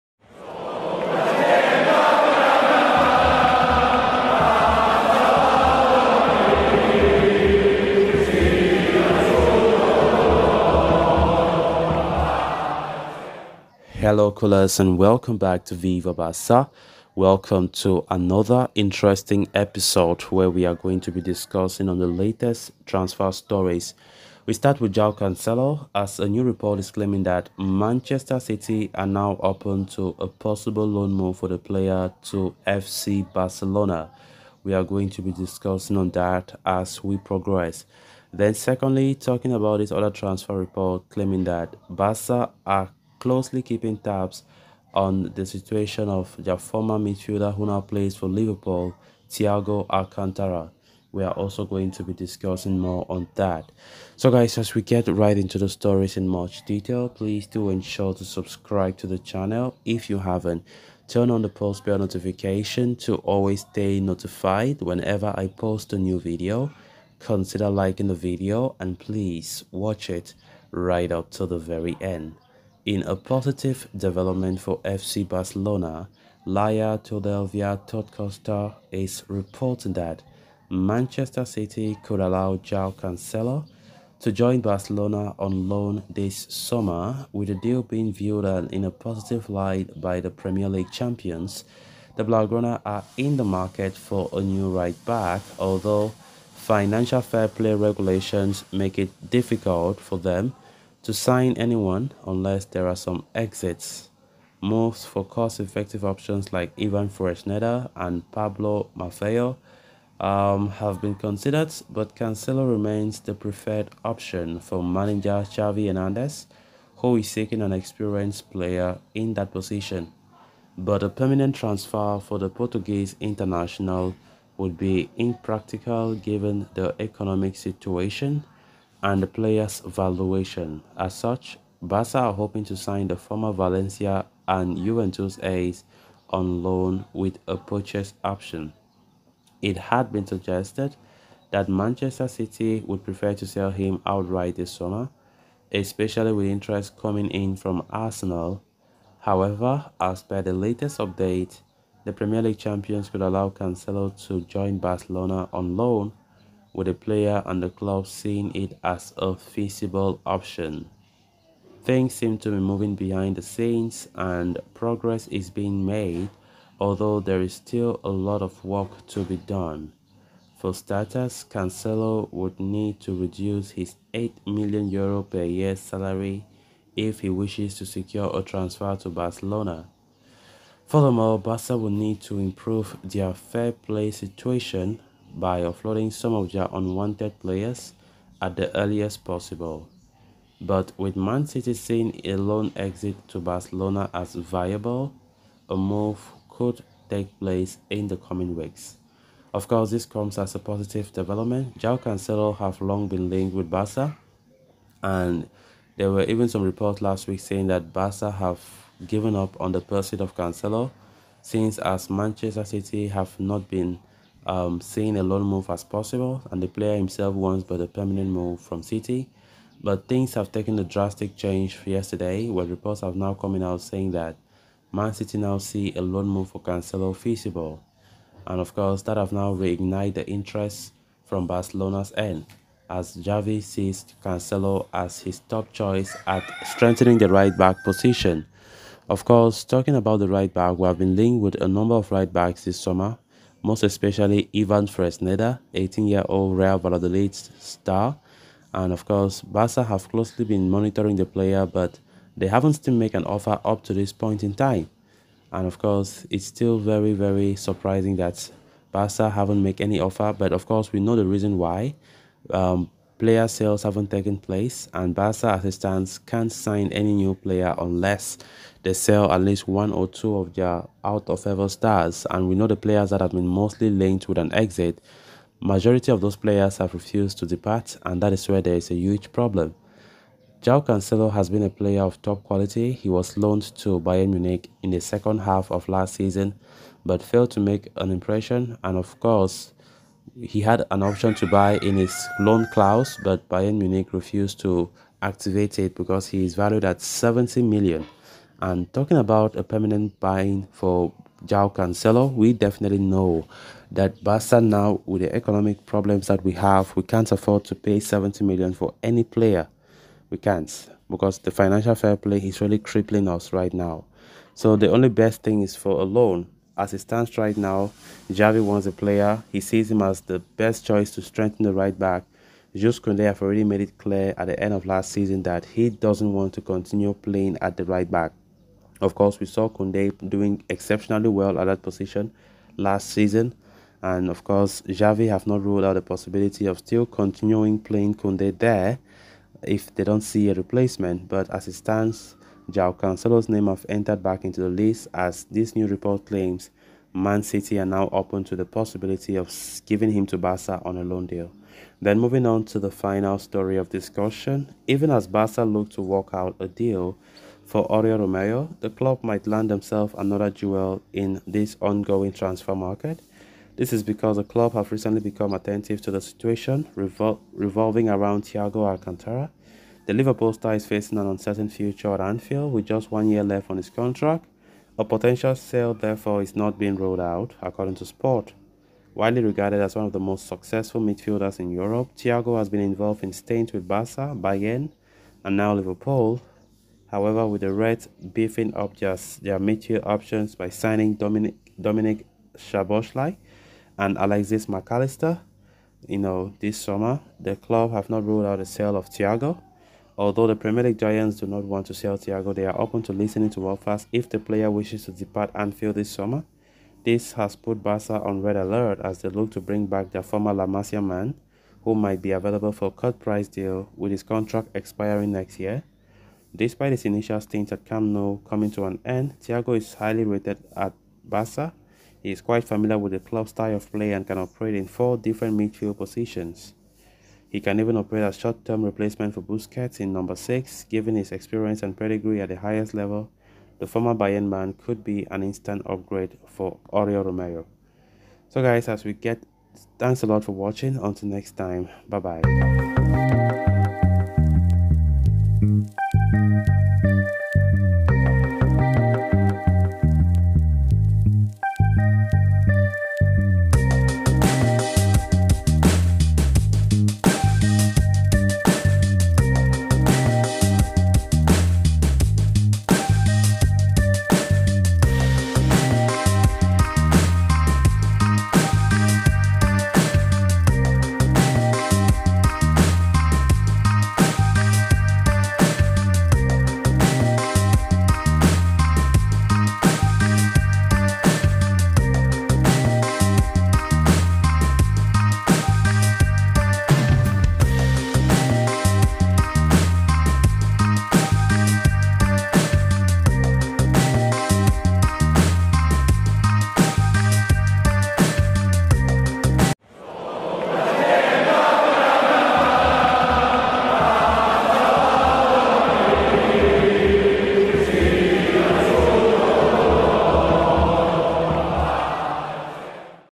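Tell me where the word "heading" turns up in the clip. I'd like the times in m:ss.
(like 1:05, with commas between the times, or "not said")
not said.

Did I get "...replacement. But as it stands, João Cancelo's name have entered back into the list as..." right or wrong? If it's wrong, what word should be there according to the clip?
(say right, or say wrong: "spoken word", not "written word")
right.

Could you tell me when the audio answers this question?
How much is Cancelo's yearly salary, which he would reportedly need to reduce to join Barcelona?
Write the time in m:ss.
2:54.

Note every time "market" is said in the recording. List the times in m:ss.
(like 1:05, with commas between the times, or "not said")
1:33, 6:02.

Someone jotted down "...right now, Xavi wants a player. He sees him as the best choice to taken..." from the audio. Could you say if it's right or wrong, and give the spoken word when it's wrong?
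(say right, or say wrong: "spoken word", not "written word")
wrong: "strengthen", not "taken".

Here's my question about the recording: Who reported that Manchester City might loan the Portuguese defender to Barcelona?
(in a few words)
Laia Todelvia Totcosta.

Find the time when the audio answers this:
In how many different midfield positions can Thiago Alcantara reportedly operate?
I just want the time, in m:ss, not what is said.
7:04.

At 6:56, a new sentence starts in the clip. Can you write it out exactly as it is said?
Despite his initial stint at Camp Nou coming to an end, Thiago is highly rated at Barca.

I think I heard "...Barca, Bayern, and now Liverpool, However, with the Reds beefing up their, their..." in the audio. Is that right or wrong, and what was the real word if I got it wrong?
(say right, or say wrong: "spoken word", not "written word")
right.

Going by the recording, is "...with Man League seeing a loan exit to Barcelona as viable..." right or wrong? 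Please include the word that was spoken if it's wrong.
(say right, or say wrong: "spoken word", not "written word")
wrong: "City", not "League".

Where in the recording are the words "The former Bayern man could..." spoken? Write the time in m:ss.
7:13.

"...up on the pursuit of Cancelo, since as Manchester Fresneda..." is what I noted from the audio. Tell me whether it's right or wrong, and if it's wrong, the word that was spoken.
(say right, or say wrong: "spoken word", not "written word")
wrong: "City", not "Fresneda".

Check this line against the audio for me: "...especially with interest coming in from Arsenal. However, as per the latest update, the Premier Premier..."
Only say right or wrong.
wrong.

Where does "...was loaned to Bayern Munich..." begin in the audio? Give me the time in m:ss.
4:43.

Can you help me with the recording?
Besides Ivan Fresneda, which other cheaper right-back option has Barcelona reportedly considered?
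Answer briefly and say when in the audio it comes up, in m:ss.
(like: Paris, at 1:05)
Pablo Maffeo, at 1:48.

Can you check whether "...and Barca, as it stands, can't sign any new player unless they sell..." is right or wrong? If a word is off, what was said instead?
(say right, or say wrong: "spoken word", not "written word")
right.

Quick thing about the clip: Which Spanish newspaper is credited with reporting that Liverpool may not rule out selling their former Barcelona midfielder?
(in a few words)
Sport.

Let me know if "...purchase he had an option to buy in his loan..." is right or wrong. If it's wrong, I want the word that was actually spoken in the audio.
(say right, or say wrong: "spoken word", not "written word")
wrong: "course", not "purchase".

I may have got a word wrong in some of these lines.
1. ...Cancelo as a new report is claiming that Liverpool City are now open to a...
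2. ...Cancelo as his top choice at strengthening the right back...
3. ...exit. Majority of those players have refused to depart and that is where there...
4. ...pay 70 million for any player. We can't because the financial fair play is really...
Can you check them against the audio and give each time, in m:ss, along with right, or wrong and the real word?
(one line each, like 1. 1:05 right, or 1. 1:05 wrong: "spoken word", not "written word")
1. 0:25 wrong: "Manchester", not "Liverpool"
2. 3:54 right
3. 4:34 right
4. 5:07 right.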